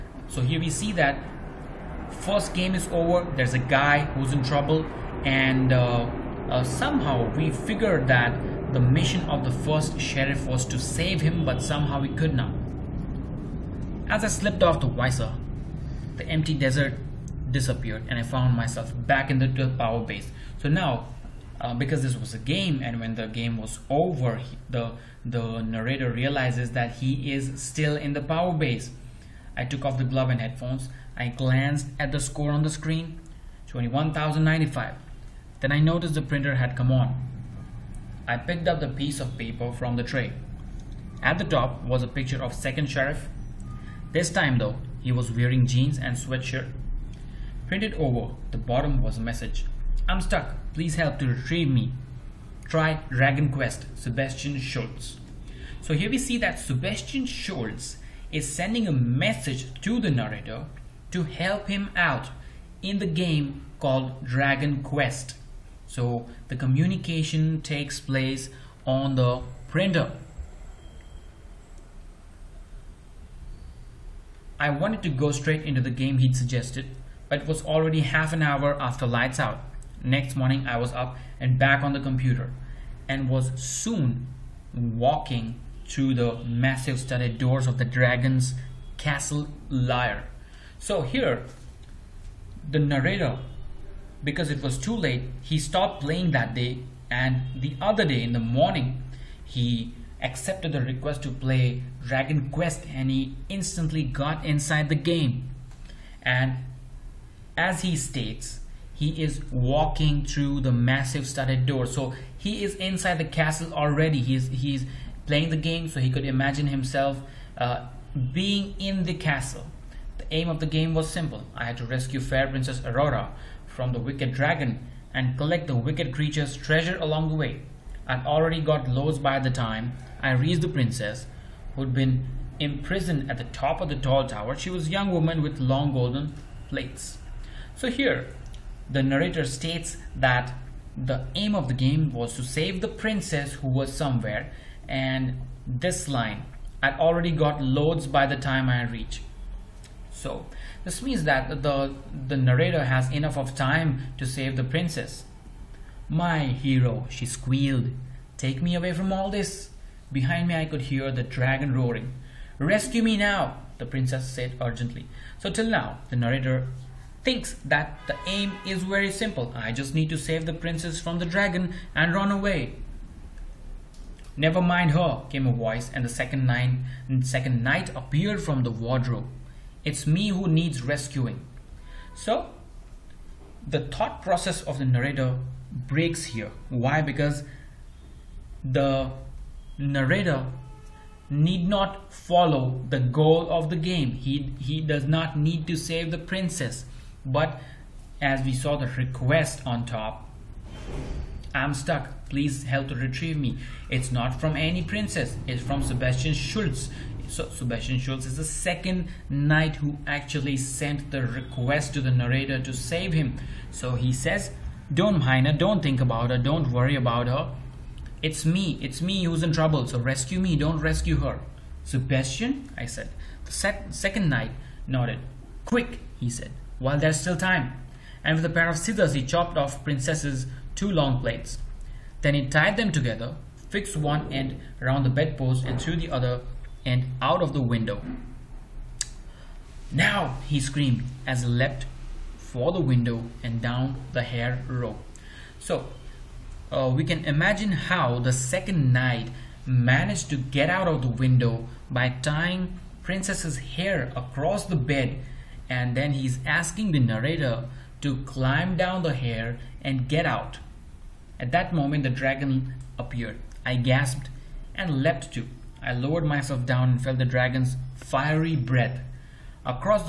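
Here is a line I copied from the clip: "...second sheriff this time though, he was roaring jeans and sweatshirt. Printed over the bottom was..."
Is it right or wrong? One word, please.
wrong.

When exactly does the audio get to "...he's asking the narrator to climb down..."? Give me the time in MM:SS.
04:16.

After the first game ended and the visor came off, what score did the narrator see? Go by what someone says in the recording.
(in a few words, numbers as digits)
21,095.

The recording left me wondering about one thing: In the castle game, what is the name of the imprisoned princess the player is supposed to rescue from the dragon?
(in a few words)
Aurora.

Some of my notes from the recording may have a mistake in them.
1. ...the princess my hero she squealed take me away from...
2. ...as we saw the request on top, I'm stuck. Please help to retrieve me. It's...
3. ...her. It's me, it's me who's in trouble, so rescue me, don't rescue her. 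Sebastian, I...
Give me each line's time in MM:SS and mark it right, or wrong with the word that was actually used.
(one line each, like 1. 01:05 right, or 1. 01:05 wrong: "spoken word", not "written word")
1. 02:34 right
2. 03:18 right
3. 03:37 right.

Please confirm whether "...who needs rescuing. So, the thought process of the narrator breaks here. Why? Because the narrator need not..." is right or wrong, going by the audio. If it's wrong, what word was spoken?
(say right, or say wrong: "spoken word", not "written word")
right.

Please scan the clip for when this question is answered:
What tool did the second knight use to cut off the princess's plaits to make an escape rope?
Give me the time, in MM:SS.
03:48.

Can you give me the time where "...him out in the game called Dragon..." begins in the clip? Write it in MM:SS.
01:01.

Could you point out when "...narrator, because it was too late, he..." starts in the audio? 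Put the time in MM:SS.
01:32.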